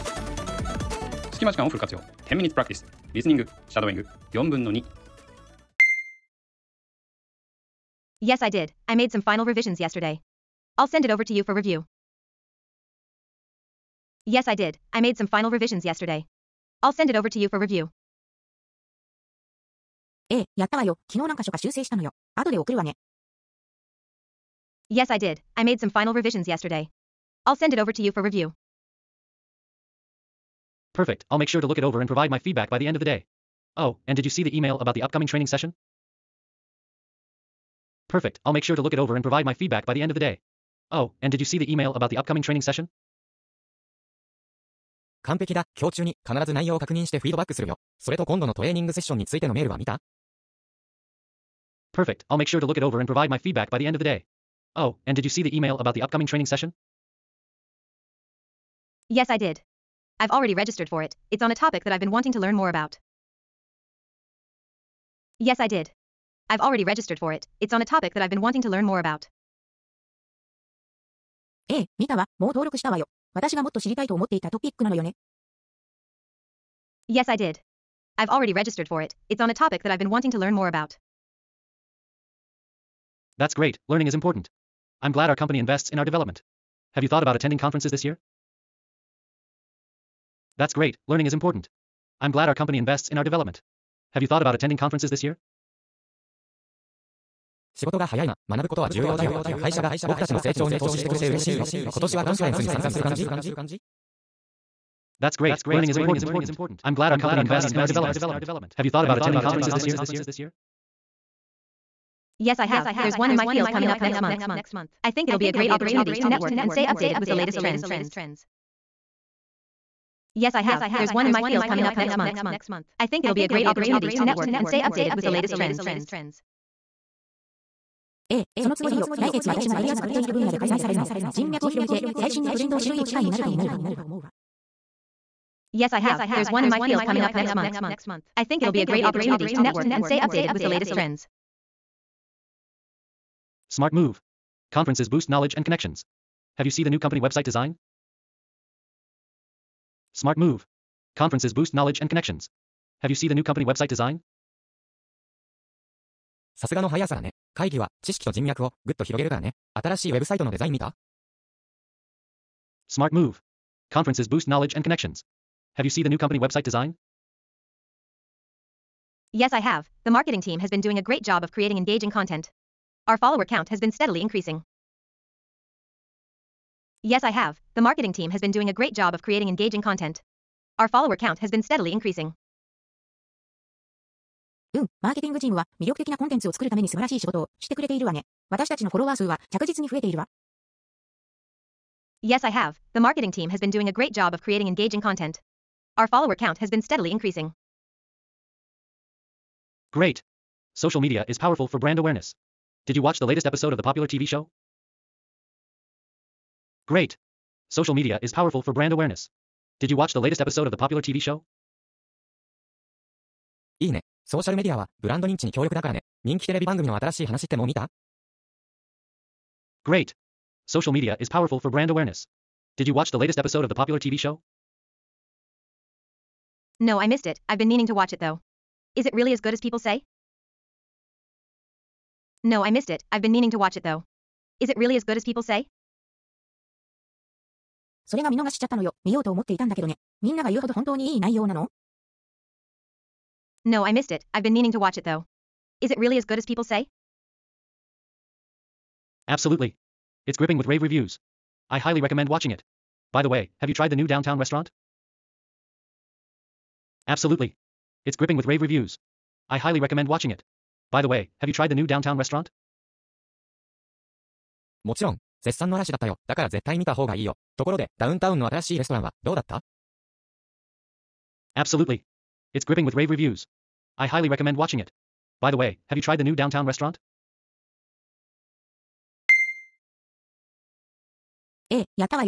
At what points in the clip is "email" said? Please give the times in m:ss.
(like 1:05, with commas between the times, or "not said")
0:34, 0:41, 0:55.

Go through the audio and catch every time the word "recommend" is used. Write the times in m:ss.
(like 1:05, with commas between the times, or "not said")
4:12, 4:19, 4:34.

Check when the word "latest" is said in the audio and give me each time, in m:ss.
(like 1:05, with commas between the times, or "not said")
1:57, 2:05, 2:20, 3:23, 3:30, 3:43.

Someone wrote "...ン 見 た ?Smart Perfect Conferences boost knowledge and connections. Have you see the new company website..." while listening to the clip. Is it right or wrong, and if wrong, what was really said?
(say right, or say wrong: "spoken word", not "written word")
wrong: "Move", not "Perfect".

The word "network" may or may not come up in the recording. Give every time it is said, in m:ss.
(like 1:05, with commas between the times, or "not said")
1:56, 2:04, 2:19.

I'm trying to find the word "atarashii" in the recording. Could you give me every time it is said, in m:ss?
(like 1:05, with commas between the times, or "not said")
3:36.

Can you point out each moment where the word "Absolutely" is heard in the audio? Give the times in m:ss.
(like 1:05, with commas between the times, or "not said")
4:09, 4:17, 4:31.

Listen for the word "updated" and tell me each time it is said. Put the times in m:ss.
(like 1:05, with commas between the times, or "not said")
1:56, 2:04, 2:20.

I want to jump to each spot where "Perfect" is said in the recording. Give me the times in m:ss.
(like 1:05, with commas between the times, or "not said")
0:30, 0:38, 0:51.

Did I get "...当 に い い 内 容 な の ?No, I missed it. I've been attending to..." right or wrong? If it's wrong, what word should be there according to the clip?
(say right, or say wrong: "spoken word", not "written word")
wrong: "meaning", not "attending".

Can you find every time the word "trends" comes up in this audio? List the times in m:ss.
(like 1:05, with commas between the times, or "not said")
1:57, 2:05, 2:20.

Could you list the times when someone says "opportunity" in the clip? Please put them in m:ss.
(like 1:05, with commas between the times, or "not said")
1:55, 2:03, 2:19.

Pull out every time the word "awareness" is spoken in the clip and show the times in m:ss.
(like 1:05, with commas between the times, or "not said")
3:21, 3:28, 3:41.